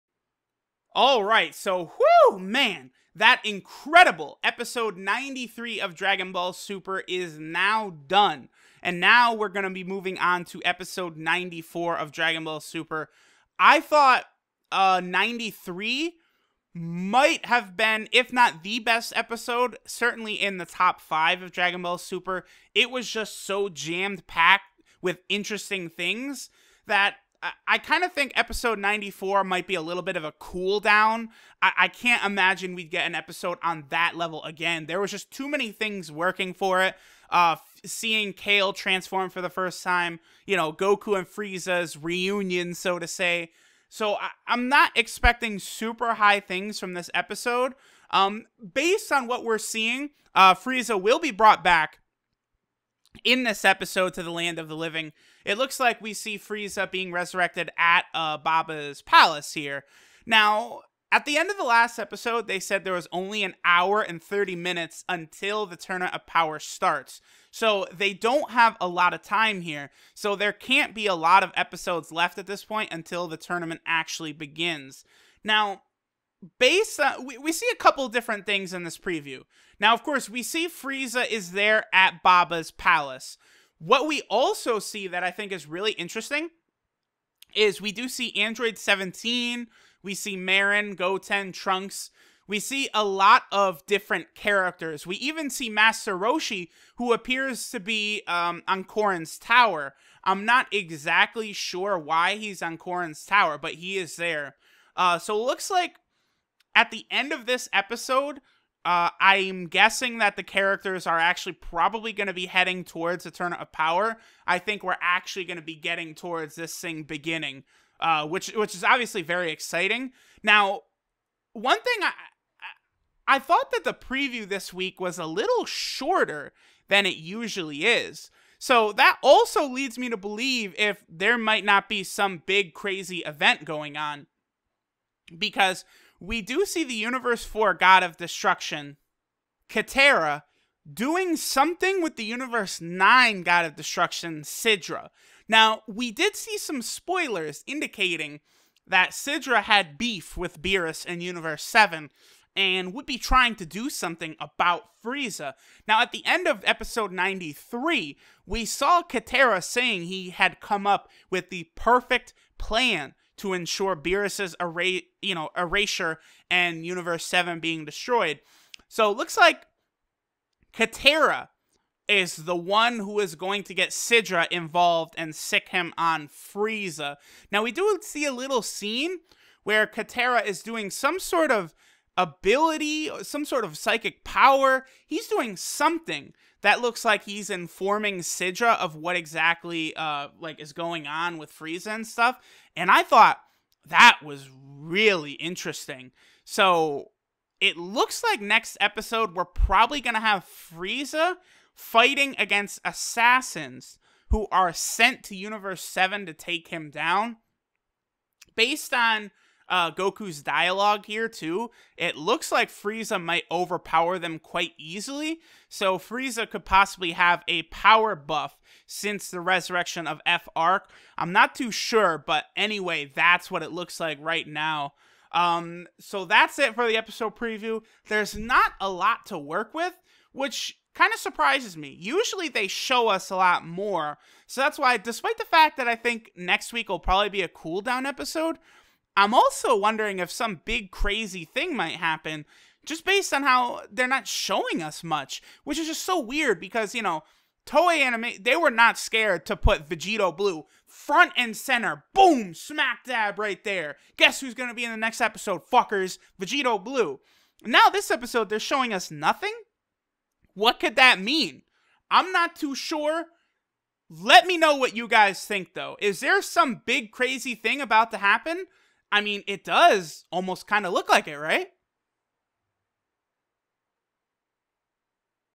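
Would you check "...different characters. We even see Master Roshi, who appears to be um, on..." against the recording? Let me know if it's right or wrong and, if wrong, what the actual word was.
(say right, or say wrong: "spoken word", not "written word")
right.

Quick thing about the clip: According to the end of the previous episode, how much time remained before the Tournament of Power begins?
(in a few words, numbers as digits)
1 hour 30 minutes.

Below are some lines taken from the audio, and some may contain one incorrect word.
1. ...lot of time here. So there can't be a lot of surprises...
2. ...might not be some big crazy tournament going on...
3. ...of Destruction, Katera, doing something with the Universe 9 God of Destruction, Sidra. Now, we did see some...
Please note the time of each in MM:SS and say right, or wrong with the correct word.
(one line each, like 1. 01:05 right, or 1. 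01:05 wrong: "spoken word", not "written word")
1. 01:08 wrong: "episodes", not "surprises"
2. 02:11 wrong: "event", not "tournament"
3. 02:18 right.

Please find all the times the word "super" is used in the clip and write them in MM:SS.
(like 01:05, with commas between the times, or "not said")
00:06, 00:12, 00:21, 00:45.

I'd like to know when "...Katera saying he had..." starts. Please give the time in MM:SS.
02:39.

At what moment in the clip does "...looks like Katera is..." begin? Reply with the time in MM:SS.
02:49.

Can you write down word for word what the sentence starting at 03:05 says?
He's doing something that looks like he's informing Sidra of what exactly uh, like is going on with Frieza and stuff.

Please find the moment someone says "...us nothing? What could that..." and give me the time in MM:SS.
04:18.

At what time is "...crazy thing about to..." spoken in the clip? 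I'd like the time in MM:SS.
04:27.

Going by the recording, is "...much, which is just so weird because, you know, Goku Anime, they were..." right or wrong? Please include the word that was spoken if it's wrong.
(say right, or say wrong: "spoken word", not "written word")
wrong: "Toei", not "Goku".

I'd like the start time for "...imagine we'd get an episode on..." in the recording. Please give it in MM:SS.
00:32.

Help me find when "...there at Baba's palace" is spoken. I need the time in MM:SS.
01:21.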